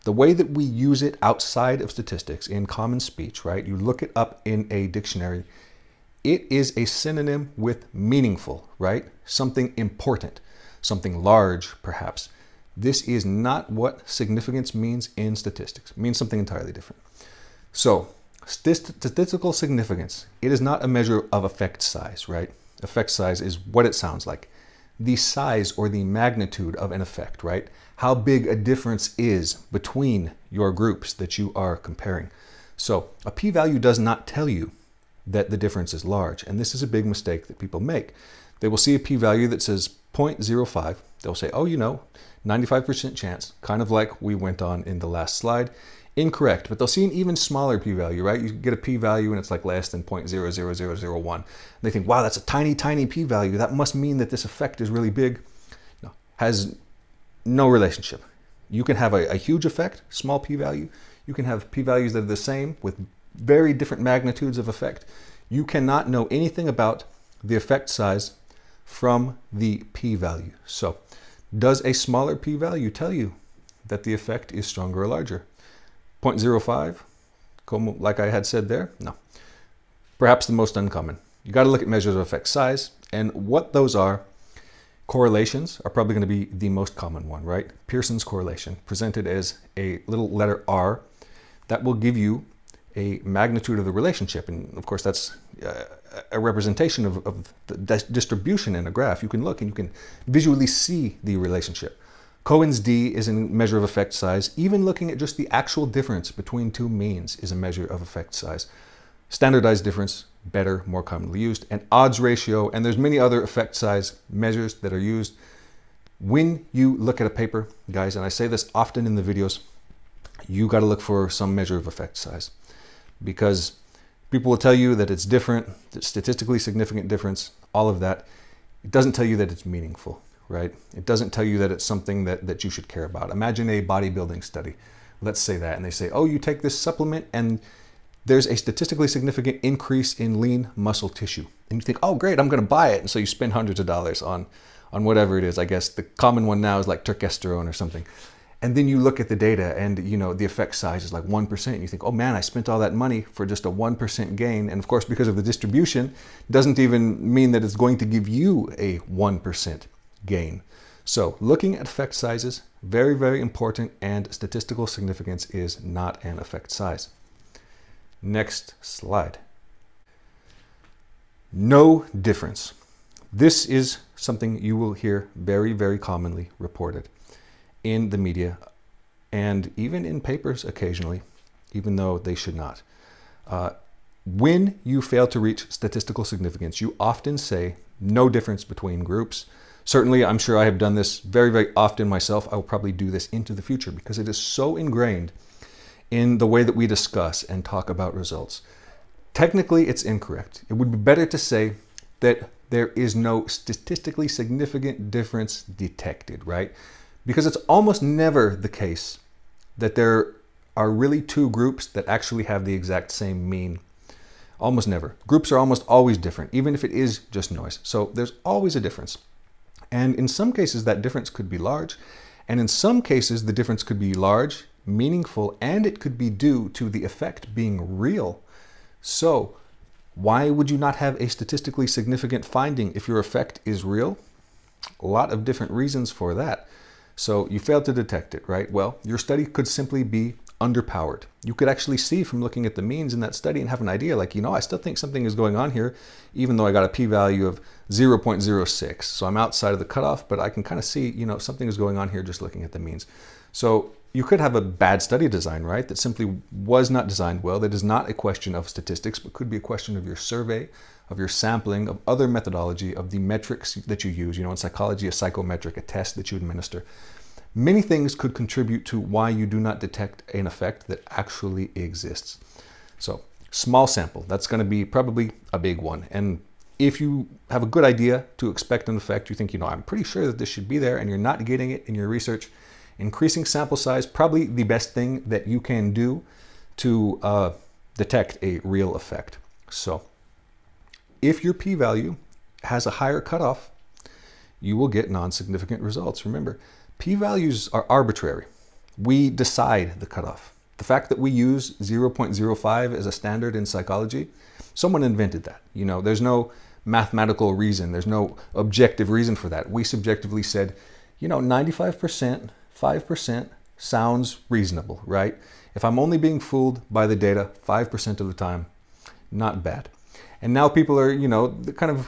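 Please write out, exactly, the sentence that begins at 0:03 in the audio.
You look it up in a dictionary, it is a synonym with meaningful, right?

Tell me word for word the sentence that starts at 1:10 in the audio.
So does a smaller p-value tell you that the effect is stronger or larger?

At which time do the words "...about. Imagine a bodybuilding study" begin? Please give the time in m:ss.
2:13.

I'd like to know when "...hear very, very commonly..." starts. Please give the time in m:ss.
2:54.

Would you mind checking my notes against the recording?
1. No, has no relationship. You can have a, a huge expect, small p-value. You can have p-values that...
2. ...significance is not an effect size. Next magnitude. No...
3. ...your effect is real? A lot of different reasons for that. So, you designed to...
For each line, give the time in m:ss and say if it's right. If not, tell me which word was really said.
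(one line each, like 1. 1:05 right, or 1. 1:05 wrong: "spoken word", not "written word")
1. 0:56 wrong: "effect", not "expect"
2. 2:44 wrong: "slide", not "magnitude"
3. 3:53 wrong: "failed", not "designed".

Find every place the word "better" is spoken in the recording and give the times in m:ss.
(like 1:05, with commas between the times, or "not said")
1:50, 3:20.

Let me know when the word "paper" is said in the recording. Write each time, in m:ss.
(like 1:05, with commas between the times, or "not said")
1:57, 3:00.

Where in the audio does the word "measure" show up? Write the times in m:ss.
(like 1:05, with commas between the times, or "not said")
0:20, 1:21, 1:43, 1:47, 1:54, 2:01.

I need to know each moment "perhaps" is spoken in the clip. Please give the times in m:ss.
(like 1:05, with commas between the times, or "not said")
0:11, 1:20.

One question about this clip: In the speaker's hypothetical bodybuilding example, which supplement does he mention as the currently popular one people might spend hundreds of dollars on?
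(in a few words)
turkesterone.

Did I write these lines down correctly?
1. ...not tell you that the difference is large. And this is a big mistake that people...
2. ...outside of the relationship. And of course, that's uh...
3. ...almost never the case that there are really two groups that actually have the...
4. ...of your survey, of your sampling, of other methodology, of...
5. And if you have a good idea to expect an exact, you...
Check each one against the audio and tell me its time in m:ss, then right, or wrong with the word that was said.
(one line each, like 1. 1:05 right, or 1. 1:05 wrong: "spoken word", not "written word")
1. 0:33 right
2. 1:33 wrong: "magnitude", not "outside"
3. 3:27 right
4. 4:19 right
5. 4:36 wrong: "effect", not "exact".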